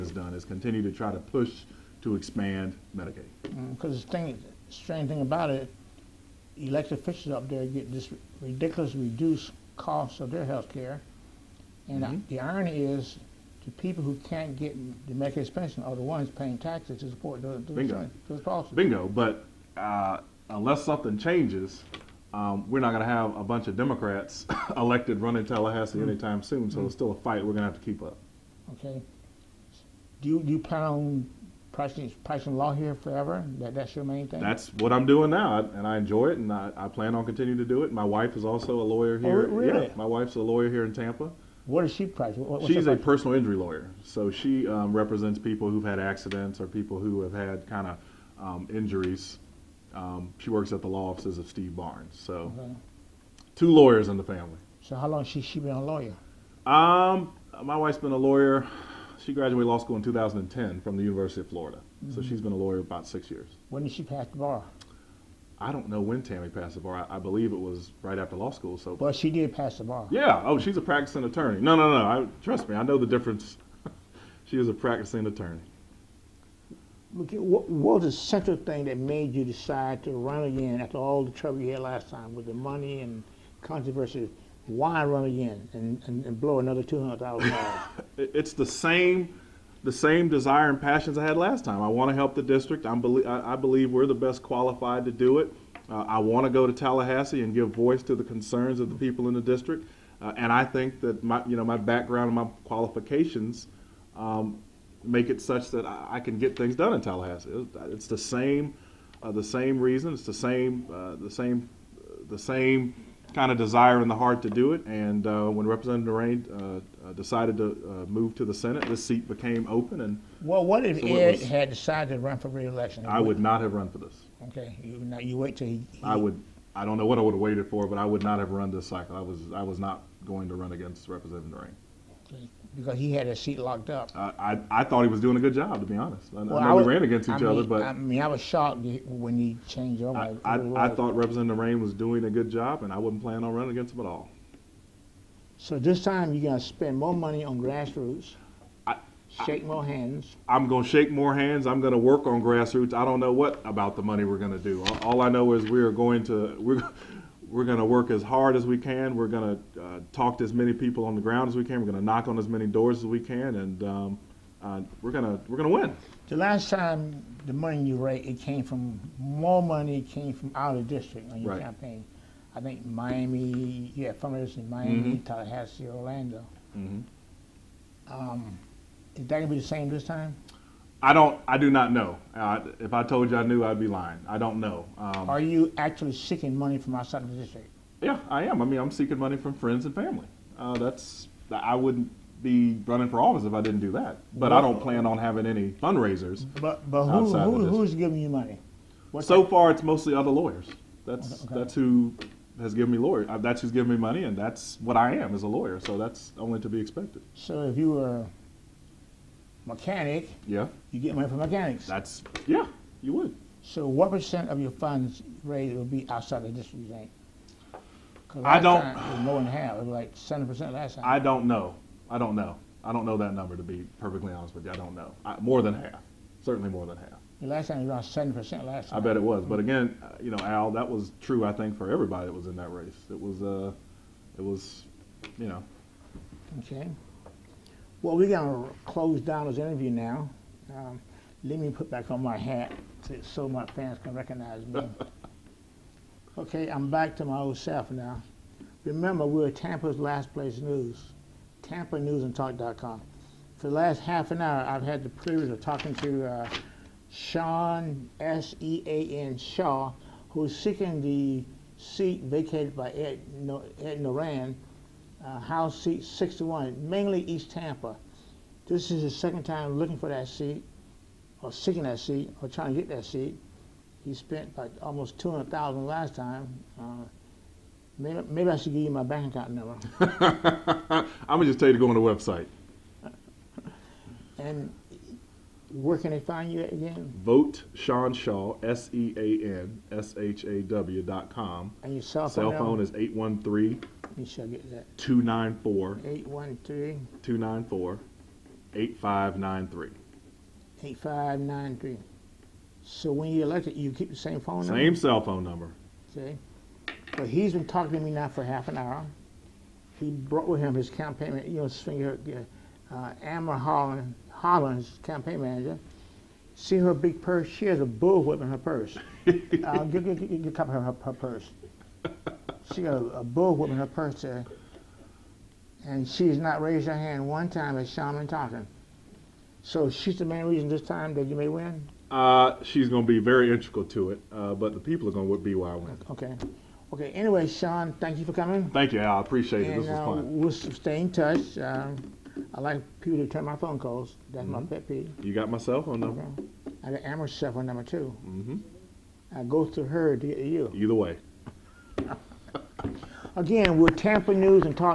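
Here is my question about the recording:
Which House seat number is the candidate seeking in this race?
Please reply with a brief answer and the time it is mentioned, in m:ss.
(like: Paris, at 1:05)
61, at 4:26.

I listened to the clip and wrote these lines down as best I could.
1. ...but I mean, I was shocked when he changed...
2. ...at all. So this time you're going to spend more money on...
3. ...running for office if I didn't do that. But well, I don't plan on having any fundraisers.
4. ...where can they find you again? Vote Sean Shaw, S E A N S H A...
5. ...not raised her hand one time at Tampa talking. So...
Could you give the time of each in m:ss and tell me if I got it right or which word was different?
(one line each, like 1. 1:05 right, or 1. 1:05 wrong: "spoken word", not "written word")
1. 2:17 right
2. 2:24 right
3. 3:12 right
4. 4:45 right
5. 5:26 wrong: "Shaman", not "Tampa".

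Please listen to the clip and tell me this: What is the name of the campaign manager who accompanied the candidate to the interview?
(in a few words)
Amber Holland.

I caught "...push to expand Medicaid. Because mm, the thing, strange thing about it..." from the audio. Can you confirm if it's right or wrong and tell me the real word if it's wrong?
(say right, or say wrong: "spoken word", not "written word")
right.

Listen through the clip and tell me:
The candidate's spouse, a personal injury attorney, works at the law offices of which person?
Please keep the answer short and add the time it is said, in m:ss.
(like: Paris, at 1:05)
Steve Barnes, at 0:51.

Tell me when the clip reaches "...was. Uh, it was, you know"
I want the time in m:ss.
3:53.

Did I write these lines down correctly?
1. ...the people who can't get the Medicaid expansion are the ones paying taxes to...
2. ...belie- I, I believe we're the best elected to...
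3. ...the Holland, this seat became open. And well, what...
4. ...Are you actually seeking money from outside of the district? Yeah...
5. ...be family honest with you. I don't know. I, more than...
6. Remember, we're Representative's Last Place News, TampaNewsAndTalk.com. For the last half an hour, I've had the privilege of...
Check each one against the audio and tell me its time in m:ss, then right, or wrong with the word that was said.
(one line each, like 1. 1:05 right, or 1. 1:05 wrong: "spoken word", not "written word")
1. 0:13 right
2. 1:33 wrong: "qualified", not "elected"
3. 1:58 wrong: "Senate", not "Holland"
4. 3:05 right
5. 3:43 wrong: "perfectly", not "family"
6. 4:08 wrong: "Tampa", not "Representative".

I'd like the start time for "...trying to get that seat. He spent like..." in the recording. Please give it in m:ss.
4:32.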